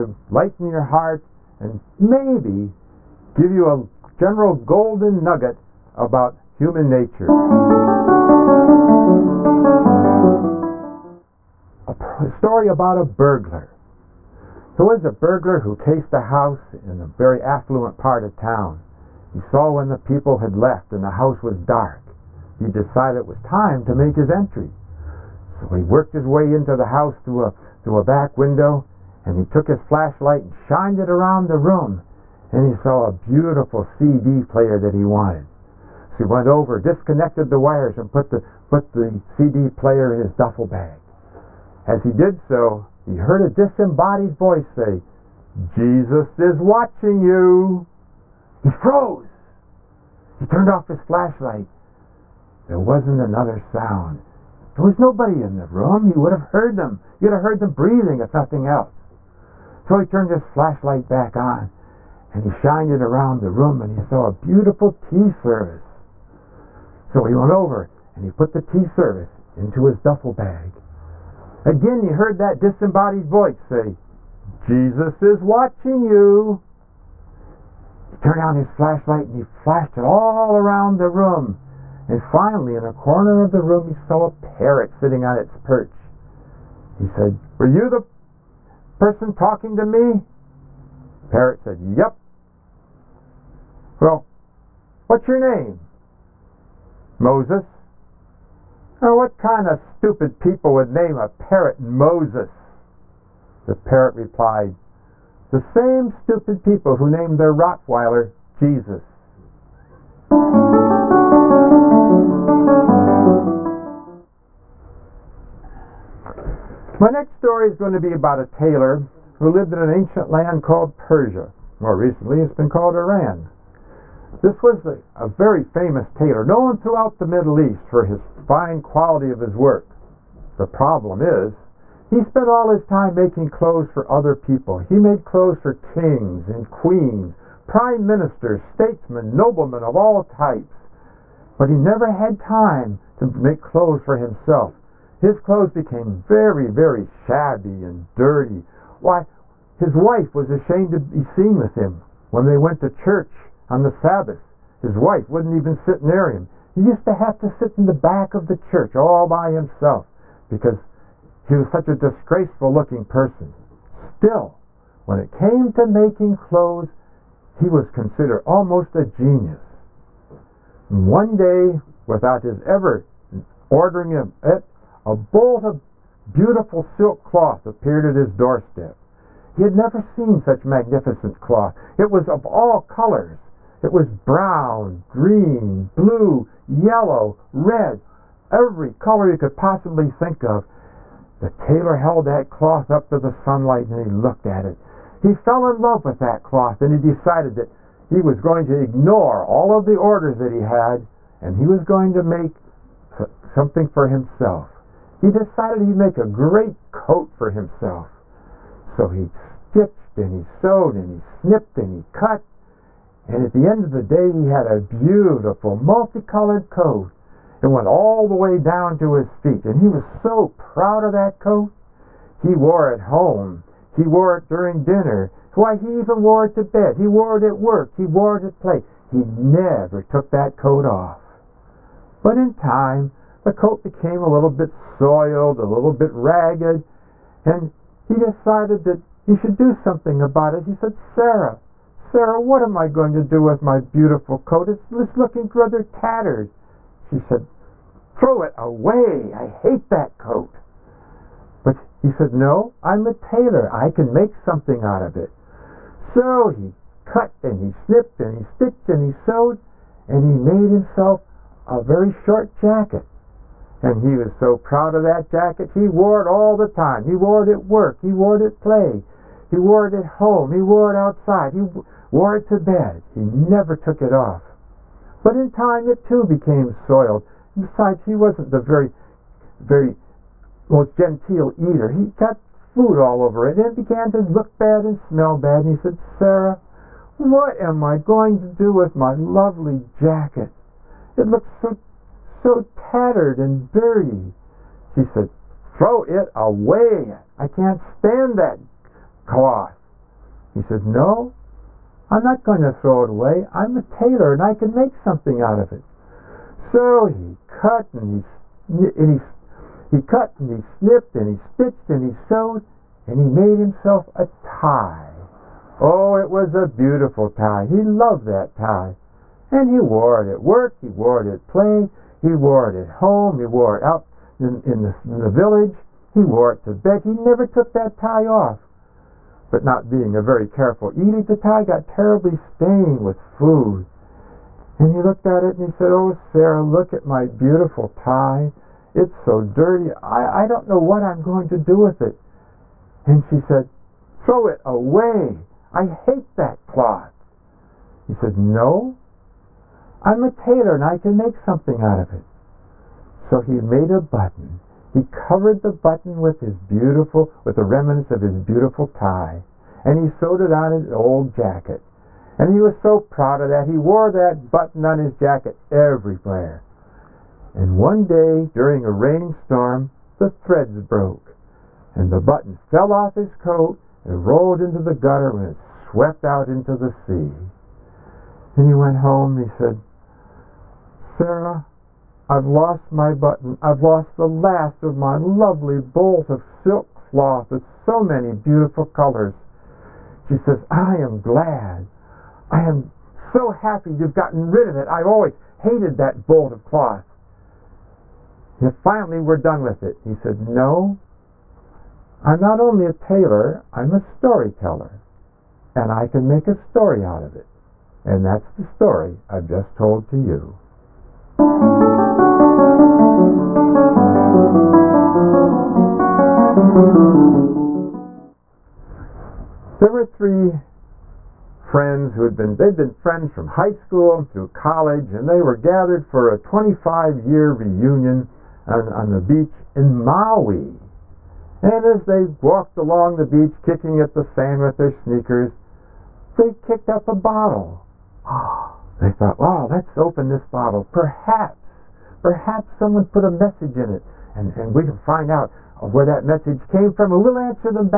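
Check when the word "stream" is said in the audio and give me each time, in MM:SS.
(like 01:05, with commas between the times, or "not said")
not said.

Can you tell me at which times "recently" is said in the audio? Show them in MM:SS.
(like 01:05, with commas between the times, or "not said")
02:01.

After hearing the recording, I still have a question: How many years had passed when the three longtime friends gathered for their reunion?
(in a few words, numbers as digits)
25.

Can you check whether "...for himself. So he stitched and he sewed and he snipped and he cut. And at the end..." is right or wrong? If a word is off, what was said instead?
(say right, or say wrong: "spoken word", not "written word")
right.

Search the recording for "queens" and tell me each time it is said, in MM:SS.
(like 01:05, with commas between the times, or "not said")
02:16.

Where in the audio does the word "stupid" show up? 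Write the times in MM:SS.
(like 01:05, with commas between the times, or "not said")
01:39, 01:46.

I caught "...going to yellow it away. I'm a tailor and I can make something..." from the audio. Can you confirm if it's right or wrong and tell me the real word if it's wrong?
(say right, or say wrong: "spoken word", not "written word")
wrong: "throw", not "yellow".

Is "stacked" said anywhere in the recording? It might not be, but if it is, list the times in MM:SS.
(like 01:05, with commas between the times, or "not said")
not said.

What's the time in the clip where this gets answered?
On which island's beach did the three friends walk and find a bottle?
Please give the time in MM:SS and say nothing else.
07:10.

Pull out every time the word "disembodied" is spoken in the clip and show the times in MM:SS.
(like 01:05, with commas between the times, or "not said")
00:43, 01:12.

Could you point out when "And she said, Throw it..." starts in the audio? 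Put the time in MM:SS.
05:43.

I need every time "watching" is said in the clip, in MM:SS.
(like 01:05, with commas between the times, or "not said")
00:46, 01:15.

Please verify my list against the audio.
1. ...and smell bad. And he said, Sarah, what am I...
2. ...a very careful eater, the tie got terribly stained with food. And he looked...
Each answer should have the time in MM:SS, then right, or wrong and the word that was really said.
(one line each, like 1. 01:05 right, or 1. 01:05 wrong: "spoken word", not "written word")
1. 04:44 right
2. 05:30 right.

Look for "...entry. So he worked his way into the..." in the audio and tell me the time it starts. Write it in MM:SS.
00:24.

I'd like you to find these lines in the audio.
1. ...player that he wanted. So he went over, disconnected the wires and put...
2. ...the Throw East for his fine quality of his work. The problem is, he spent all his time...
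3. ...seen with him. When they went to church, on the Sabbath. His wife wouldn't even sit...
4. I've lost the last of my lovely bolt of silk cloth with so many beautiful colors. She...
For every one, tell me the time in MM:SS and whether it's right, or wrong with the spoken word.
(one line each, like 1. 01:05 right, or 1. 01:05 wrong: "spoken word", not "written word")
1. 00:34 right
2. 02:07 wrong: "Middle", not "Throw"
3. 02:31 right
4. 06:23 right.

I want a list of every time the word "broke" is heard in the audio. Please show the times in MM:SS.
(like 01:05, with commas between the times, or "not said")
06:10.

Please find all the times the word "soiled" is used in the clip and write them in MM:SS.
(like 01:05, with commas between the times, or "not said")
03:54, 04:36.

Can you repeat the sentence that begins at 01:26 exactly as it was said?
He said, Were you the person talking to me?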